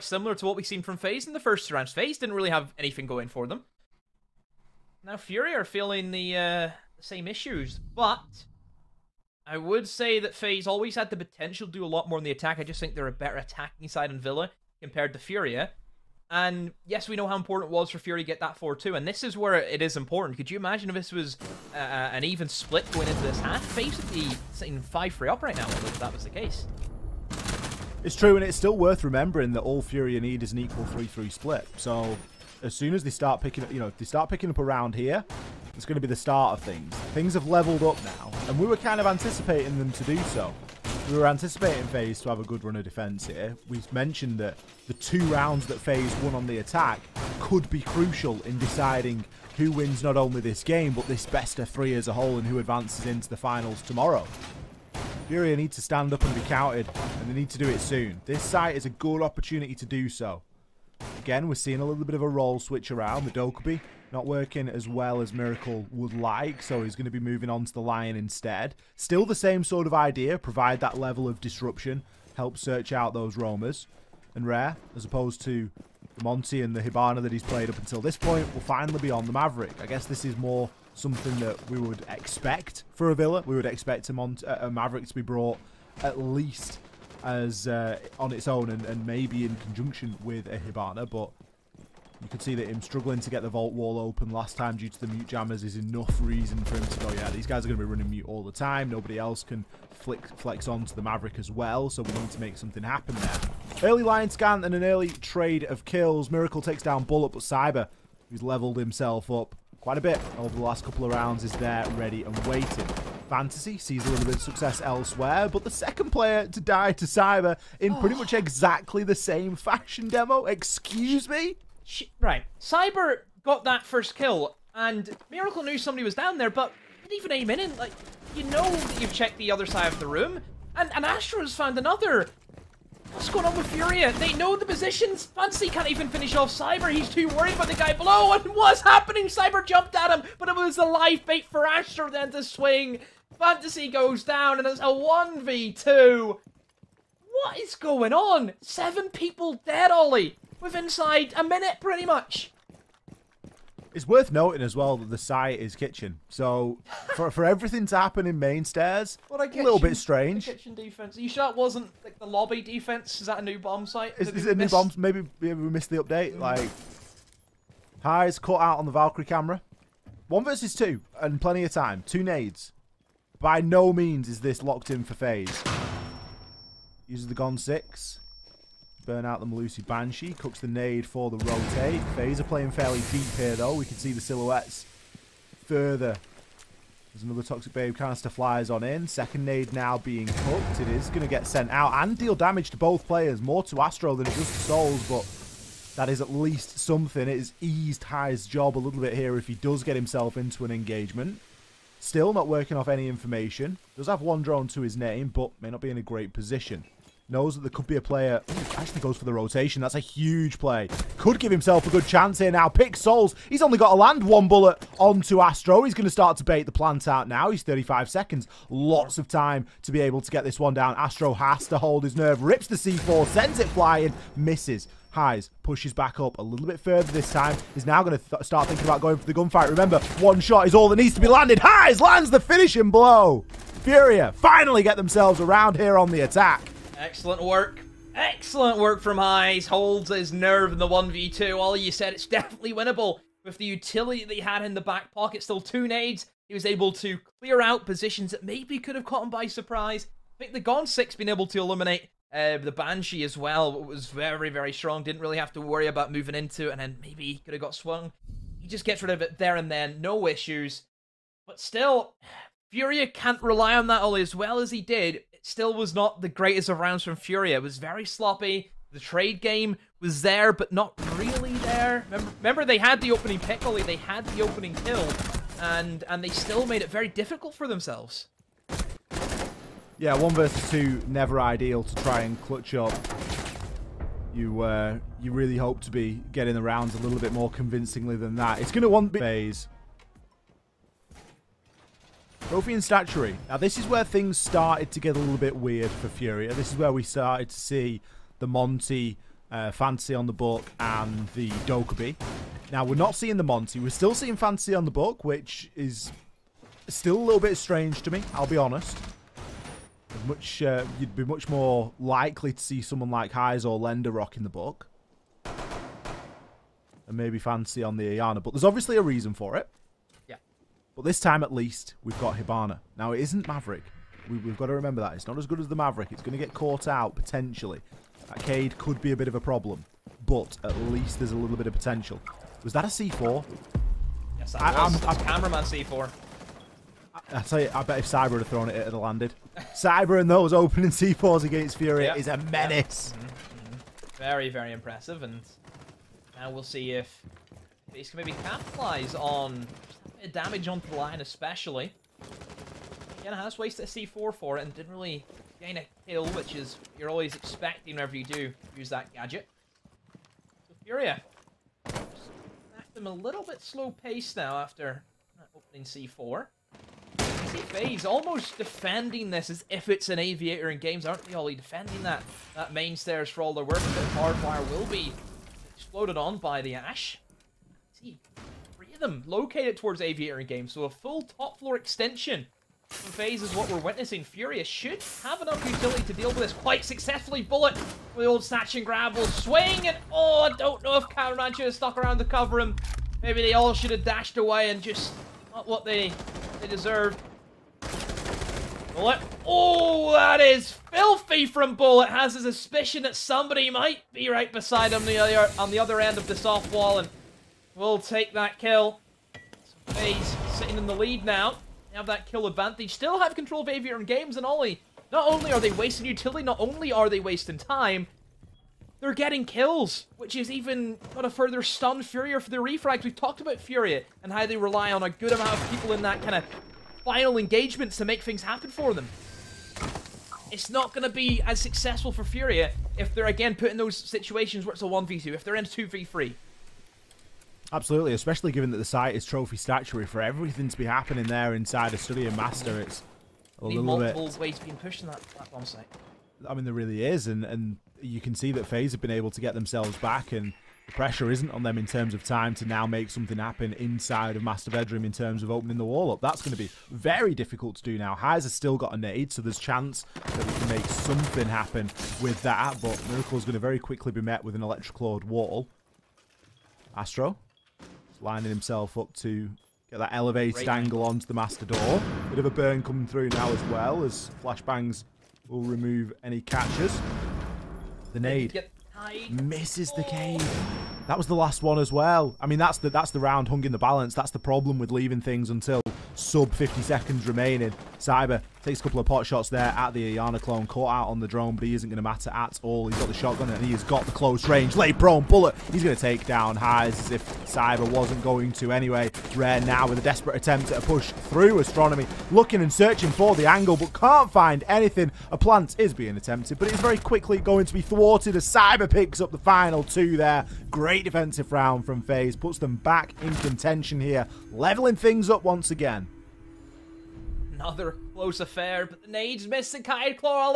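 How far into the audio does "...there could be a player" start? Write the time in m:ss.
3:27.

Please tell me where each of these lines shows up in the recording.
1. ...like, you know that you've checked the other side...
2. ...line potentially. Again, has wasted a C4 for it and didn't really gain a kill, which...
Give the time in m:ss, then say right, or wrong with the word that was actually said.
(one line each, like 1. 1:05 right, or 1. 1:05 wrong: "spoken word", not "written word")
1. 2:07 right
2. 5:50 wrong: "especially", not "potentially".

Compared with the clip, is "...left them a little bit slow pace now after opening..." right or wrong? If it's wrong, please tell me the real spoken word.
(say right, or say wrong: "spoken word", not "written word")
right.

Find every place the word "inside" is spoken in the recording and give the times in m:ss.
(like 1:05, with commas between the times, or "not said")
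2:30, 7:21, 7:33.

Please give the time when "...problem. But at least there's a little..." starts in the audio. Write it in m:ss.
5:29.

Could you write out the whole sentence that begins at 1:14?
And Rare, as opposed to Monty and the Hibana that he's played up until this point, will finally be on the Maverick.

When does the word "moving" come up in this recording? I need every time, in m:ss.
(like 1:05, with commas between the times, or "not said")
1:07, 4:16.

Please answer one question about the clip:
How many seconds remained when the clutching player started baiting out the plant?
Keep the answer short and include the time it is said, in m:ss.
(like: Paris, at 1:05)
35, at 3:37.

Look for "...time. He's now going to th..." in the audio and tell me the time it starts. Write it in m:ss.
3:47.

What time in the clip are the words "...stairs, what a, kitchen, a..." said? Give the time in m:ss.
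2:38.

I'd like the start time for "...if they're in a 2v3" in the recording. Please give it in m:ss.
7:15.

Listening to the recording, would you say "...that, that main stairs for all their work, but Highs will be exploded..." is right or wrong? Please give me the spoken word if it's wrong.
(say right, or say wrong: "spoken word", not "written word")
wrong: "Hardwire", not "Highs".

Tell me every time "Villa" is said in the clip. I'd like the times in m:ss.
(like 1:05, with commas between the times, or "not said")
0:14, 1:23.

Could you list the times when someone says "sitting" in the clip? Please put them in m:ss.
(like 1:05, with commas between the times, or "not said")
0:24, 6:50.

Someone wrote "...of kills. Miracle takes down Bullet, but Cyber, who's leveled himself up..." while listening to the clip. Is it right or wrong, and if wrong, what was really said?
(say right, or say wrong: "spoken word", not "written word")
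right.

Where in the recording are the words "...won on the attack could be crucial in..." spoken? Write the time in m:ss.
0:46.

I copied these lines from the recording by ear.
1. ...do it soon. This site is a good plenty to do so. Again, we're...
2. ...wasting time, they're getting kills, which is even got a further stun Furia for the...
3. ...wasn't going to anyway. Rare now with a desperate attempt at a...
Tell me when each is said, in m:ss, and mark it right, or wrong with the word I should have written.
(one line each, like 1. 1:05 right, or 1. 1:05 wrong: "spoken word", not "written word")
1. 0:57 wrong: "opportunity", not "plenty"
2. 6:57 right
3. 8:17 right.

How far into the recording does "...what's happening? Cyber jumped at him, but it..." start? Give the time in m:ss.
2:18.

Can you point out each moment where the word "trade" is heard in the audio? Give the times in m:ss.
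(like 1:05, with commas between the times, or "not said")
1:45, 4:28.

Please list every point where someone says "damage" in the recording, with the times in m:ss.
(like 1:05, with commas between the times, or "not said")
3:12, 5:50.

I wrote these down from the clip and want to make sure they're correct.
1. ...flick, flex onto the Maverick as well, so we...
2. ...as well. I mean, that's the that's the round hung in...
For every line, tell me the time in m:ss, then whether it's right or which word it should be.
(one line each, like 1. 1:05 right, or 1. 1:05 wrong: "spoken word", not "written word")
1. 1:39 right
2. 8:01 right.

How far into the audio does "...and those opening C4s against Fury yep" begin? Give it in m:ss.
5:40.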